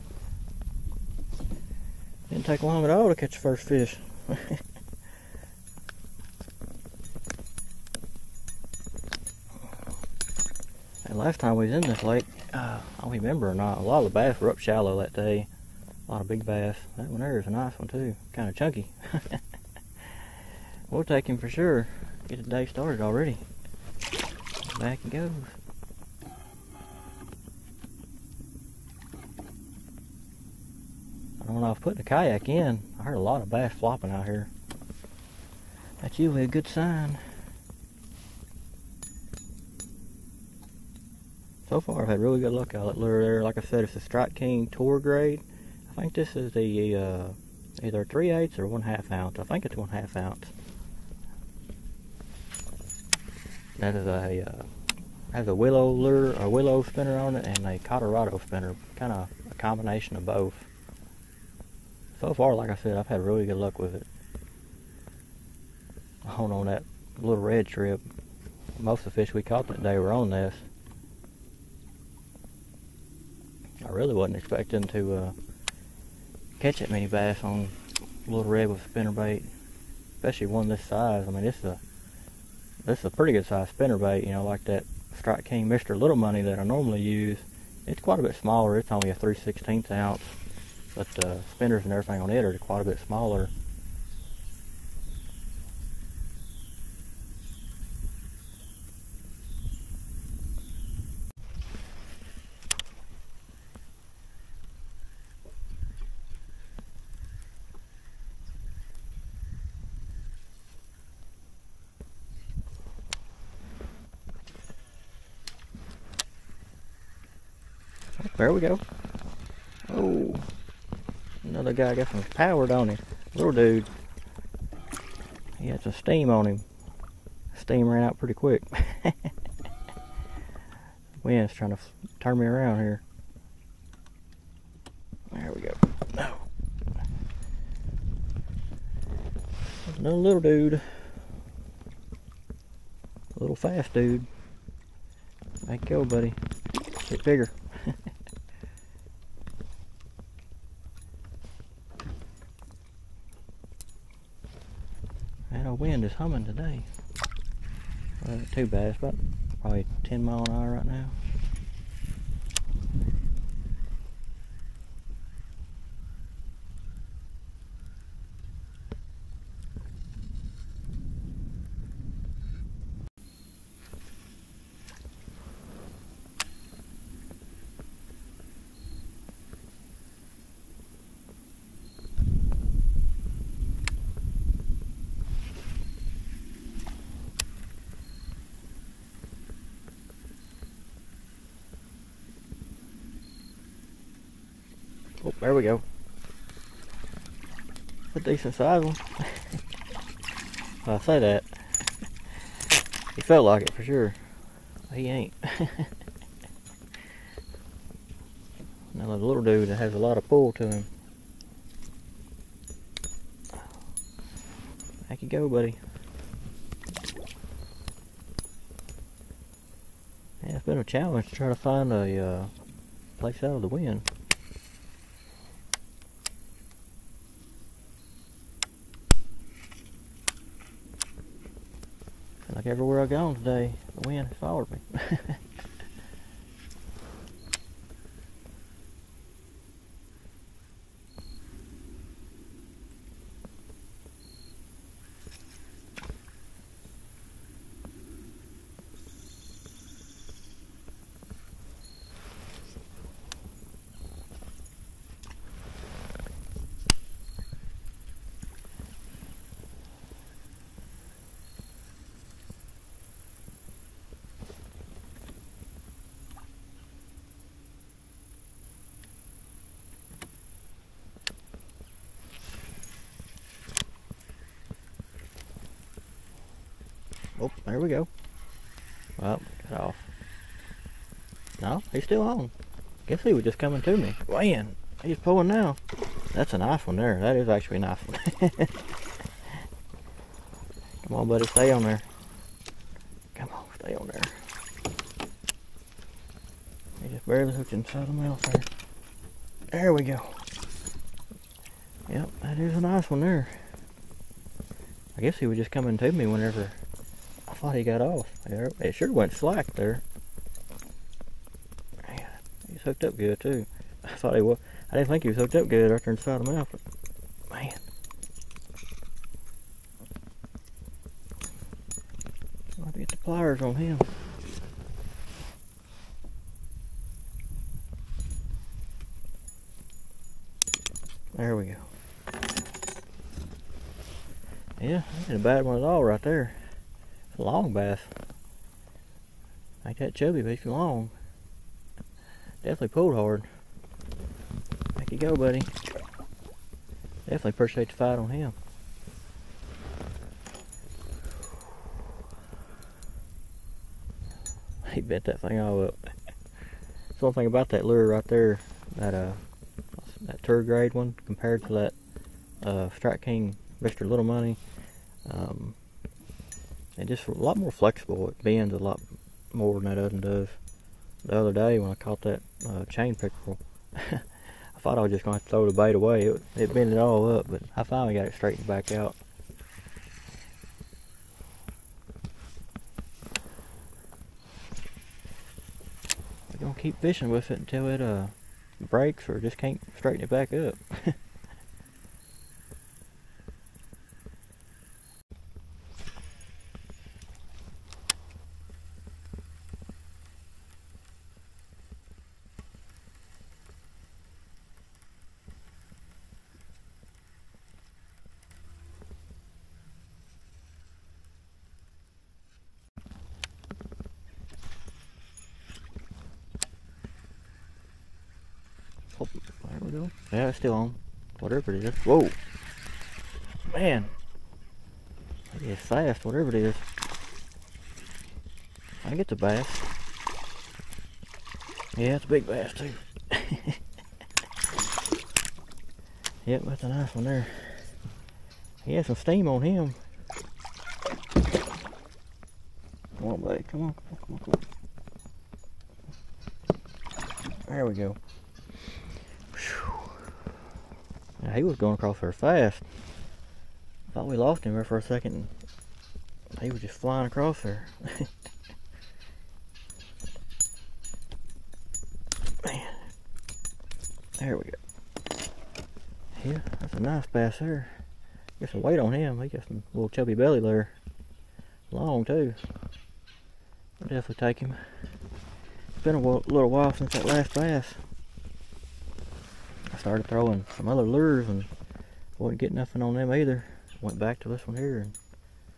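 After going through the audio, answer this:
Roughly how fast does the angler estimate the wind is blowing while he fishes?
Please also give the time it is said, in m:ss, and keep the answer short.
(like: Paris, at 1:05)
10 mph, at 2:40.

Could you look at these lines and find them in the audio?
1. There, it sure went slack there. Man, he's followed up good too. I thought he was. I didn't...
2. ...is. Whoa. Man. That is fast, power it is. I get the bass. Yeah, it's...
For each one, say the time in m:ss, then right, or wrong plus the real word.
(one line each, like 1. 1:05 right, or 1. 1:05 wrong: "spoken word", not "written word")
1. 5:08 wrong: "hooked", not "followed"
2. 7:01 wrong: "whatever", not "power".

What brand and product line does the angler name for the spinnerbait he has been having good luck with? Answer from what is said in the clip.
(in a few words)
Strike King Tour Grade.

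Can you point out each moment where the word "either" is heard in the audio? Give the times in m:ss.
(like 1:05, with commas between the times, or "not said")
0:47, 8:03.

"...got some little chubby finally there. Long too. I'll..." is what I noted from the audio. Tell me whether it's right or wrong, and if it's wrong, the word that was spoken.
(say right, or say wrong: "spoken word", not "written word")
wrong: "belly", not "finally".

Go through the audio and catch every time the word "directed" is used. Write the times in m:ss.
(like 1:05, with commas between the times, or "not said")
not said.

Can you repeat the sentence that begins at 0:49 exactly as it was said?
I think it's 1 half ounce.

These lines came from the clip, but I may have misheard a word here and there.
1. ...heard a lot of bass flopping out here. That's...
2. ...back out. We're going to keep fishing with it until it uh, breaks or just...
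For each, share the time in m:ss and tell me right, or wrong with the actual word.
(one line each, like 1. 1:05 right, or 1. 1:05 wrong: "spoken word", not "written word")
1. 0:33 right
2. 6:18 right.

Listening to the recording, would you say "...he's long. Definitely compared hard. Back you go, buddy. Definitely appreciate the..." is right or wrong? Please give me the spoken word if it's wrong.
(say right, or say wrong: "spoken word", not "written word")
wrong: "pulled", not "compared".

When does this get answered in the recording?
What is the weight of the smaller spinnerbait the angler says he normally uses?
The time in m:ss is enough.
1:29.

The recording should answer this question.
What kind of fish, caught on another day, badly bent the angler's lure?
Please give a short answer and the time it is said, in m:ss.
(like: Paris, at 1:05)
Chain pickerel, at 6:12.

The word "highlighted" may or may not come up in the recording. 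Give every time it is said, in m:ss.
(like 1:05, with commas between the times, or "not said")
not said.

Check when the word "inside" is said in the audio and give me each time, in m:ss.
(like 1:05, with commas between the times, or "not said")
4:57, 5:16.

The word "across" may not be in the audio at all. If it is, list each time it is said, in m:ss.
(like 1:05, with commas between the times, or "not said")
7:31, 7:37.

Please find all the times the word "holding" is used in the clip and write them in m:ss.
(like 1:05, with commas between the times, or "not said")
not said.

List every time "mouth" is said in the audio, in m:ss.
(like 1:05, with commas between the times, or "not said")
4:58, 5:16.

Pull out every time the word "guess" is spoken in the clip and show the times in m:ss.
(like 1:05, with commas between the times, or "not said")
4:43, 5:05.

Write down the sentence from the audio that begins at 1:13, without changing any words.
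I really wasn't expecting to uh, catch that many bass on little red with spinnerbait, especially one this size.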